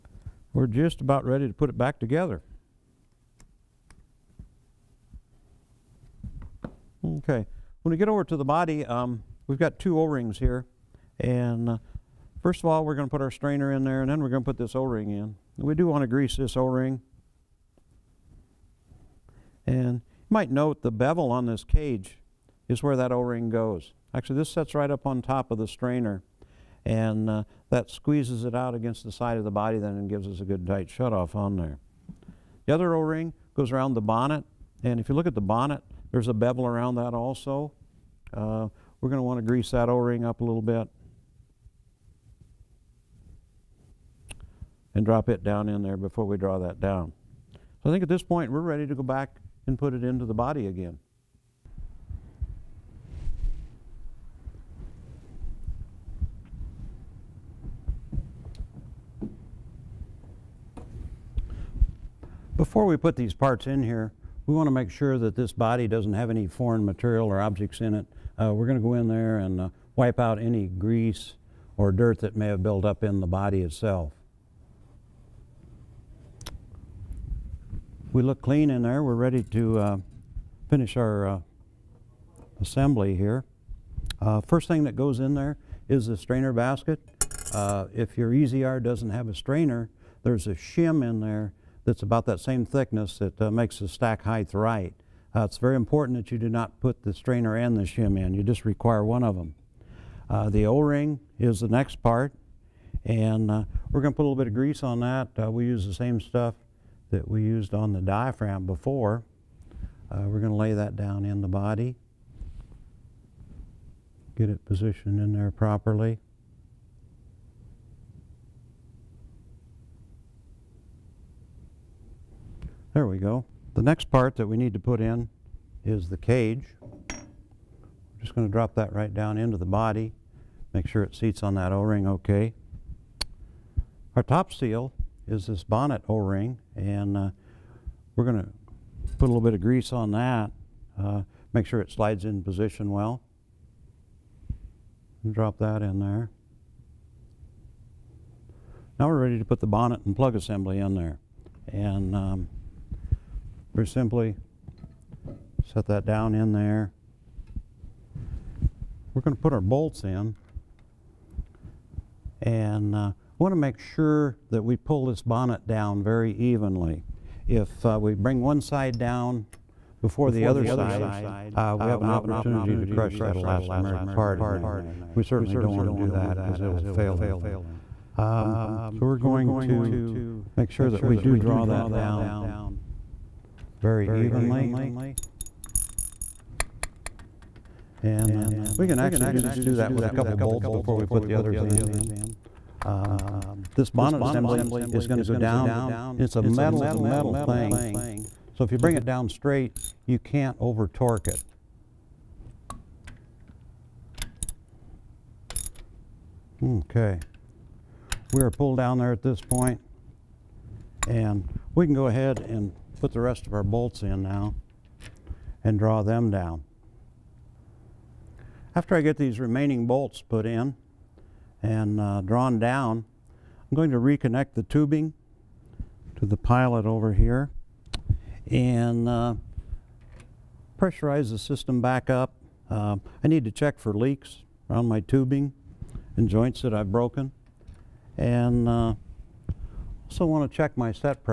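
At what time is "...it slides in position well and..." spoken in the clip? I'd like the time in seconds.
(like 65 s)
141 s.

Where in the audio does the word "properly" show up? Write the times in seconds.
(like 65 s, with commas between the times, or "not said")
115 s.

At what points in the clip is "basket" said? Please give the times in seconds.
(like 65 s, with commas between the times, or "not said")
86 s.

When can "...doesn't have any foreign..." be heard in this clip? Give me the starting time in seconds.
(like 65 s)
65 s.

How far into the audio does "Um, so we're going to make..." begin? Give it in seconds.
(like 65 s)
178 s.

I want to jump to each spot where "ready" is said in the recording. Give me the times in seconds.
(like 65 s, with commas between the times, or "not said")
1 s, 48 s, 79 s, 149 s.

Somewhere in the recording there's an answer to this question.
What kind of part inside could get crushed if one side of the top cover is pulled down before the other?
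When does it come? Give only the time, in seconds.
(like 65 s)
173 s.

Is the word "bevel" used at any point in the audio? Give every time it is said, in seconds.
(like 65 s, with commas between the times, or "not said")
20 s, 36 s.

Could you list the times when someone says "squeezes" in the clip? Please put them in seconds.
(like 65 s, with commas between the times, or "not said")
27 s.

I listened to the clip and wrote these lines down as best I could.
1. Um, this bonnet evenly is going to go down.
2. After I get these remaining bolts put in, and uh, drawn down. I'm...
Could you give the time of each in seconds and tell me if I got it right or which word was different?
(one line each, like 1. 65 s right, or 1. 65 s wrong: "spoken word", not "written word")
1. 192 s wrong: "assembly", not "evenly"
2. 218 s right.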